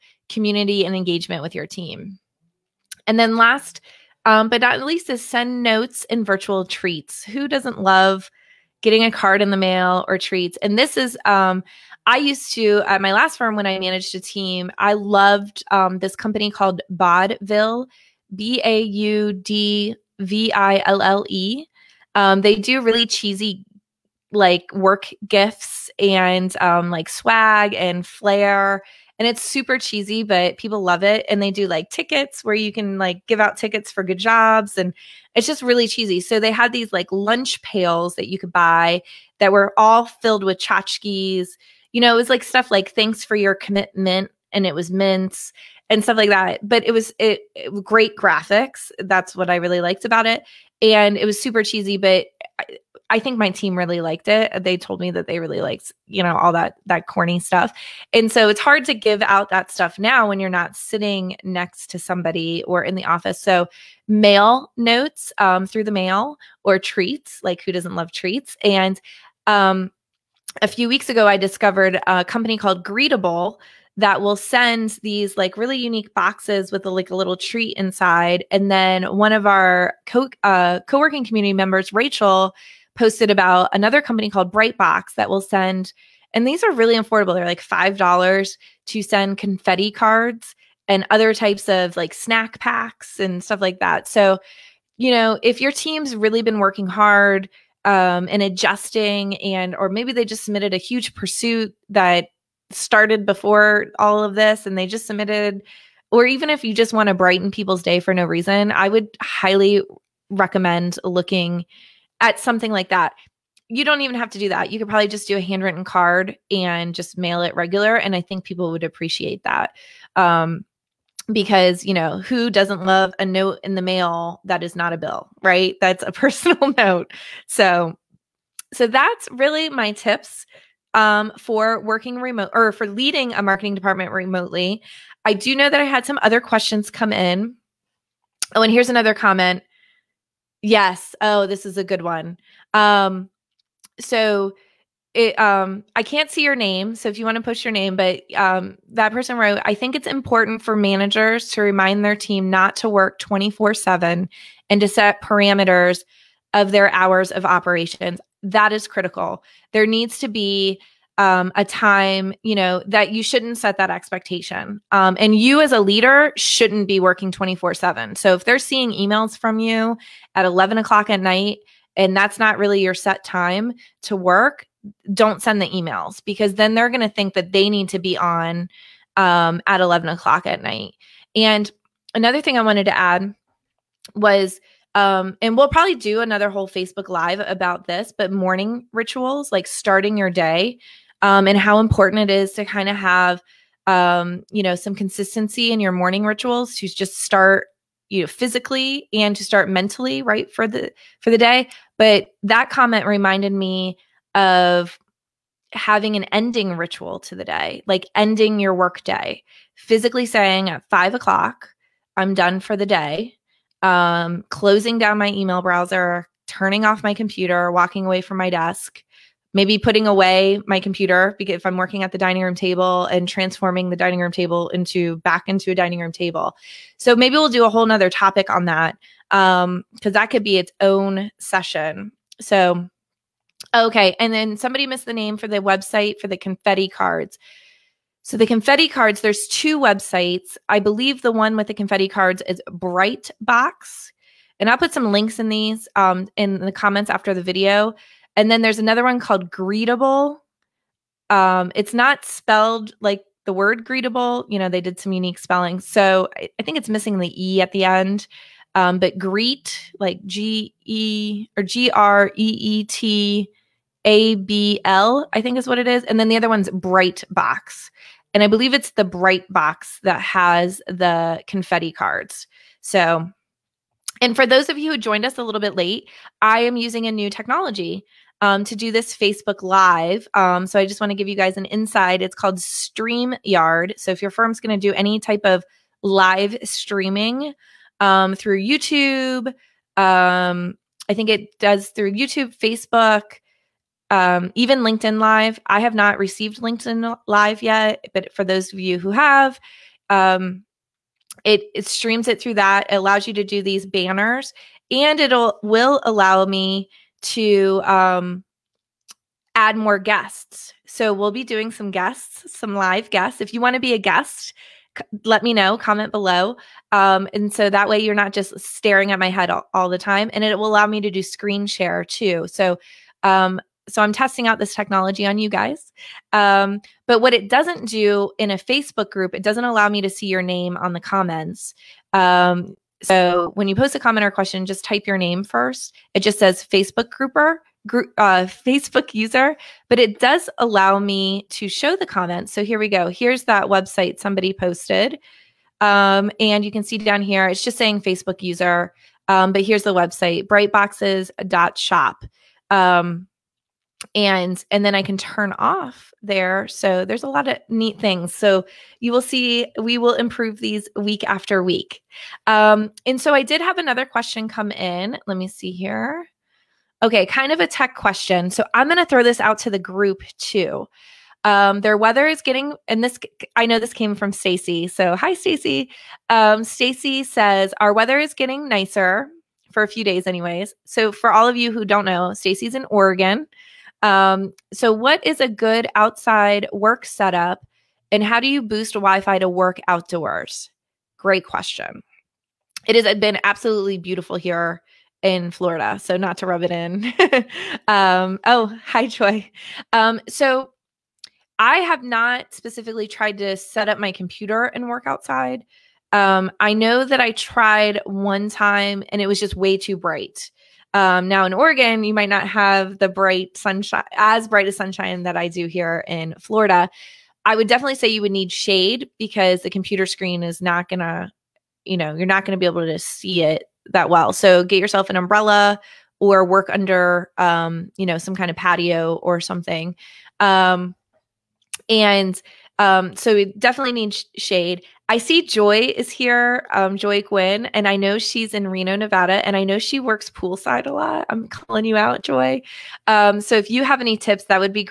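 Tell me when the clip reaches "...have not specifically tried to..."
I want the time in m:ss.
6:41.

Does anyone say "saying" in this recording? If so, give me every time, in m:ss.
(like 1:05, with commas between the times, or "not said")
3:30, 5:47.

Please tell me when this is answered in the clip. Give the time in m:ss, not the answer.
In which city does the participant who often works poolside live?
7:18.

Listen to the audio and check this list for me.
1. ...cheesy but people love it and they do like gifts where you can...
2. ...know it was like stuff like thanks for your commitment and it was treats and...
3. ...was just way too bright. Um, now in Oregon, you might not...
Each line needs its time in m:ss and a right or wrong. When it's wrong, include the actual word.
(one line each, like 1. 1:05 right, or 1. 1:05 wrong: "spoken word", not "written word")
1. 0:29 wrong: "tickets", not "gifts"
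2. 0:42 wrong: "mints", not "treats"
3. 6:49 right.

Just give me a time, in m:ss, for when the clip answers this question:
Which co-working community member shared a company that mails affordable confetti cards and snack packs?
1:21.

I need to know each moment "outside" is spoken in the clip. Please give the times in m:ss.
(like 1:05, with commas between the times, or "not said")
6:25, 6:45.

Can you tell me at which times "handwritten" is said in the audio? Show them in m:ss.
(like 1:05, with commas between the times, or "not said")
1:55.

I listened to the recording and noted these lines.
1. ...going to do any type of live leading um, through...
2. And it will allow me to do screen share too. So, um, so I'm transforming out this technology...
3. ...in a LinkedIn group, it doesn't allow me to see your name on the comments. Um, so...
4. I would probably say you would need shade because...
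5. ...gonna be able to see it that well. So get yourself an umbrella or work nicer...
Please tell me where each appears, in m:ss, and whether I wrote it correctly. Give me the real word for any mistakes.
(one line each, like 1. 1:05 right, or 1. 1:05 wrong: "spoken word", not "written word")
1. 4:44 wrong: "streaming", not "leading"
2. 5:20 wrong: "testing", not "transforming"
3. 5:28 wrong: "Facebook", not "LinkedIn"
4. 6:57 wrong: "definitely", not "probably"
5. 7:02 wrong: "under", not "nicer".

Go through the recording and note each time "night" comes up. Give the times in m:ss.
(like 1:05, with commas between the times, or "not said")
2:51, 3:00.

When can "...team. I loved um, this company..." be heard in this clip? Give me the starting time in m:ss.
0:14.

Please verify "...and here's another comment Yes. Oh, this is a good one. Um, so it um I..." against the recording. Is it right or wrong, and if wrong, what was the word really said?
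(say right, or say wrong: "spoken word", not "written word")
right.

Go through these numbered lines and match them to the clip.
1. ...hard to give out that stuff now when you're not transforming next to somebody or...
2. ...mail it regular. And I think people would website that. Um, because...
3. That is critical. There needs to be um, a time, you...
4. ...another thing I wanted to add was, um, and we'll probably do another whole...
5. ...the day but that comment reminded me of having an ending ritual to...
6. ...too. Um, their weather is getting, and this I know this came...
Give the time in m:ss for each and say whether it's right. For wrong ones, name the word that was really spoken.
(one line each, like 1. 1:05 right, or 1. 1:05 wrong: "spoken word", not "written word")
1. 0:58 wrong: "sitting", not "transforming"
2. 1:57 wrong: "appreciate", not "website"
3. 2:38 right
4. 3:02 right
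5. 3:21 right
6. 6:10 right.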